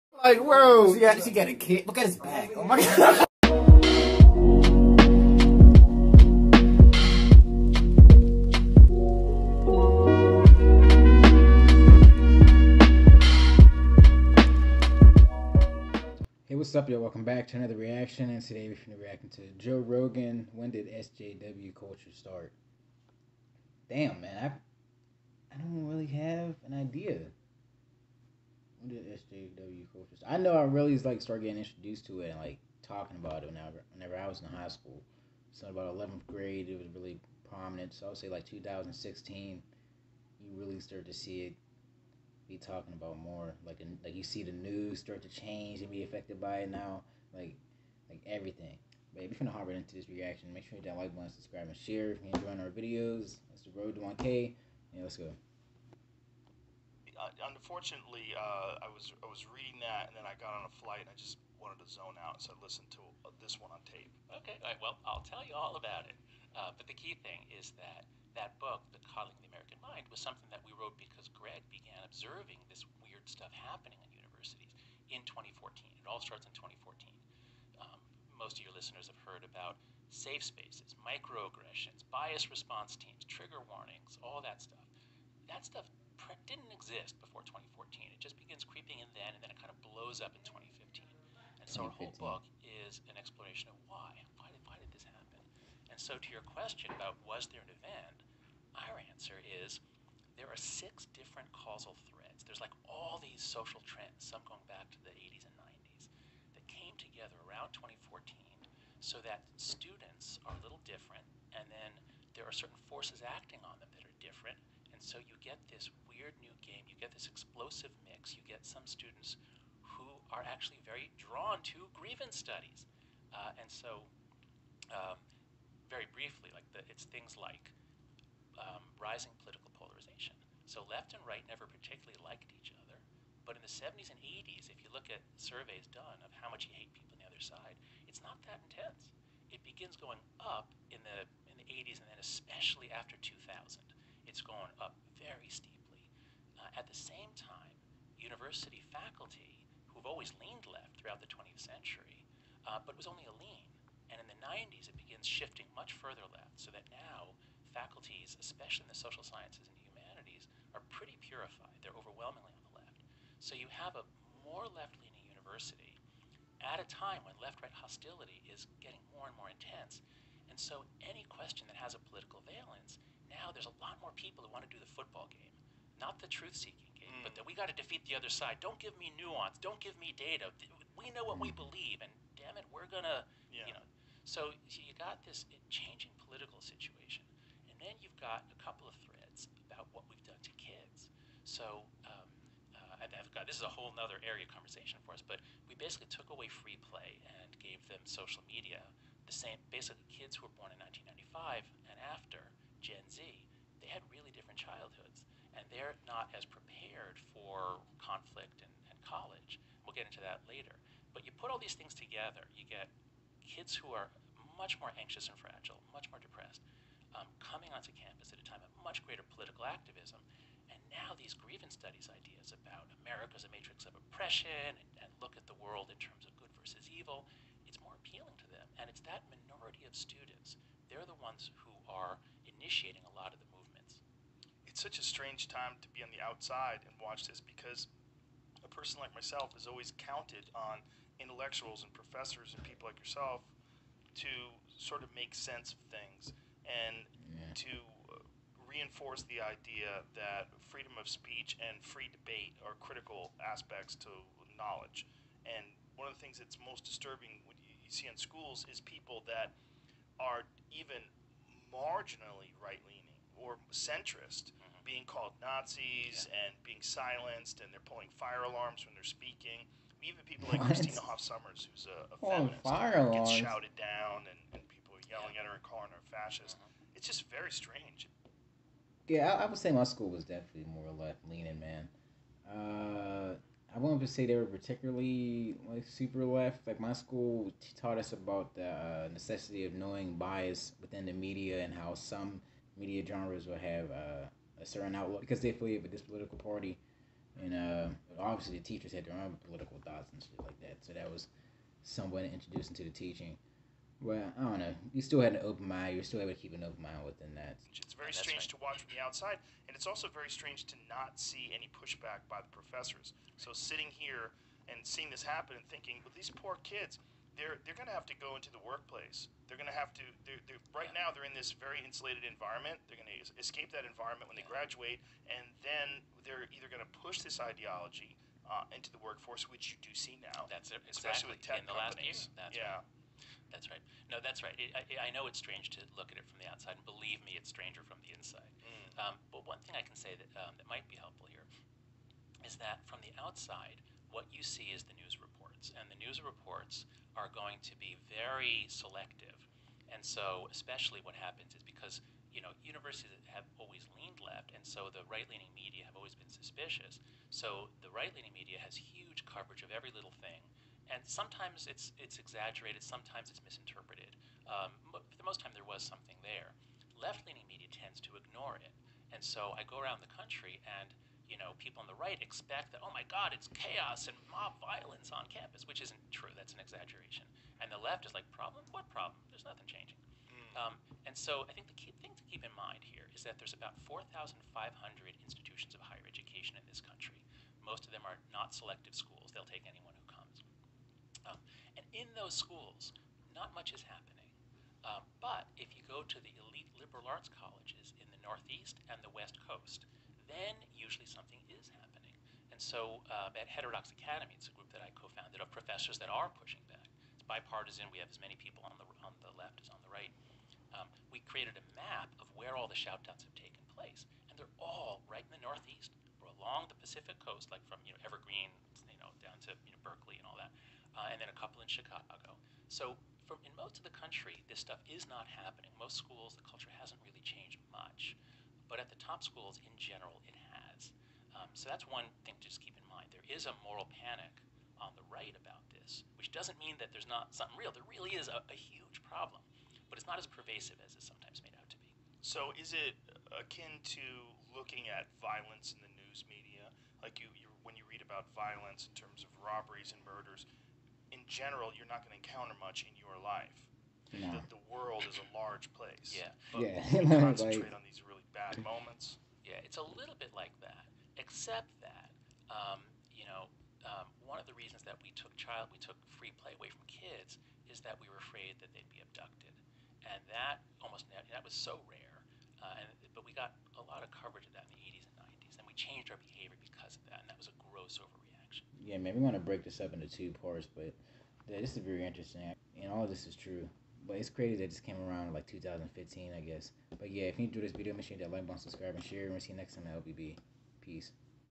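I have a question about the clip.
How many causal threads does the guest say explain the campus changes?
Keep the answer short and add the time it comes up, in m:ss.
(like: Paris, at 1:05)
6, at 1:40.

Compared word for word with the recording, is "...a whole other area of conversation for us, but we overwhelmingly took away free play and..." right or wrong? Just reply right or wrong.
wrong.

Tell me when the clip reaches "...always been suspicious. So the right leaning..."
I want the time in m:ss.
5:55.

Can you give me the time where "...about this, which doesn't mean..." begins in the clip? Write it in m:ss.
7:15.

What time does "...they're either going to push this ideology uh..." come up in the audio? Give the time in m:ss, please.
5:26.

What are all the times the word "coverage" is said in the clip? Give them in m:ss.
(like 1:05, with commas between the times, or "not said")
5:59, 7:54.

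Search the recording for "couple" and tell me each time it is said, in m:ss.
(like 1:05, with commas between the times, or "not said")
3:08, 7:01.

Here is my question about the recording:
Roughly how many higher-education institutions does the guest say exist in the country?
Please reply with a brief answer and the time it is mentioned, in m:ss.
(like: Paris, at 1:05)
4,500, at 6:23.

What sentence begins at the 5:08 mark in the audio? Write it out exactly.
to watch from the outside, and it's also very strange to not see any pushback by the professors.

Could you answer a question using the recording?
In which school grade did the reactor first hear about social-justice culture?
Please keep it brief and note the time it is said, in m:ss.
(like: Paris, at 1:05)
eleventh grade, at 0:35.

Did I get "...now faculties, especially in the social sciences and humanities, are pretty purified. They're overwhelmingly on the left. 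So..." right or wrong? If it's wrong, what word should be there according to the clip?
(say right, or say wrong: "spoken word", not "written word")
right.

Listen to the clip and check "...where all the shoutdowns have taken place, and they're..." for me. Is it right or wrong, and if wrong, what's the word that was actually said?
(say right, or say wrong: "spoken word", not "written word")
right.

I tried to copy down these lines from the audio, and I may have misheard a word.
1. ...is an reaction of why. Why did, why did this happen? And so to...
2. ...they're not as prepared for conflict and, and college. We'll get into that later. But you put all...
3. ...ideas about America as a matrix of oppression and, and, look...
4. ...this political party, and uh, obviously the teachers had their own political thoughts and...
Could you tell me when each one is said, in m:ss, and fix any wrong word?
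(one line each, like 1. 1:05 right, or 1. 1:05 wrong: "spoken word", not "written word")
1. 1:32 wrong: "explanation", not "reaction"
2. 3:25 right
3. 3:42 right
4. 4:55 right.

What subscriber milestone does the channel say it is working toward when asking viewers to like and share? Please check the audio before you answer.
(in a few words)
1K.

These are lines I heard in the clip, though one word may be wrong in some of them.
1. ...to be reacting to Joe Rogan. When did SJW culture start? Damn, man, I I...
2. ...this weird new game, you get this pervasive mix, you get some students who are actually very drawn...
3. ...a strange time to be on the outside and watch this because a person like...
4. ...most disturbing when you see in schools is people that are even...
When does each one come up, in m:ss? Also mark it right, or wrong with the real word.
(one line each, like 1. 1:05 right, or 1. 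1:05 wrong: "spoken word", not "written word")
1. 0:18 right
2. 1:55 wrong: "explosive", not "pervasive"
3. 3:54 right
4. 4:16 right.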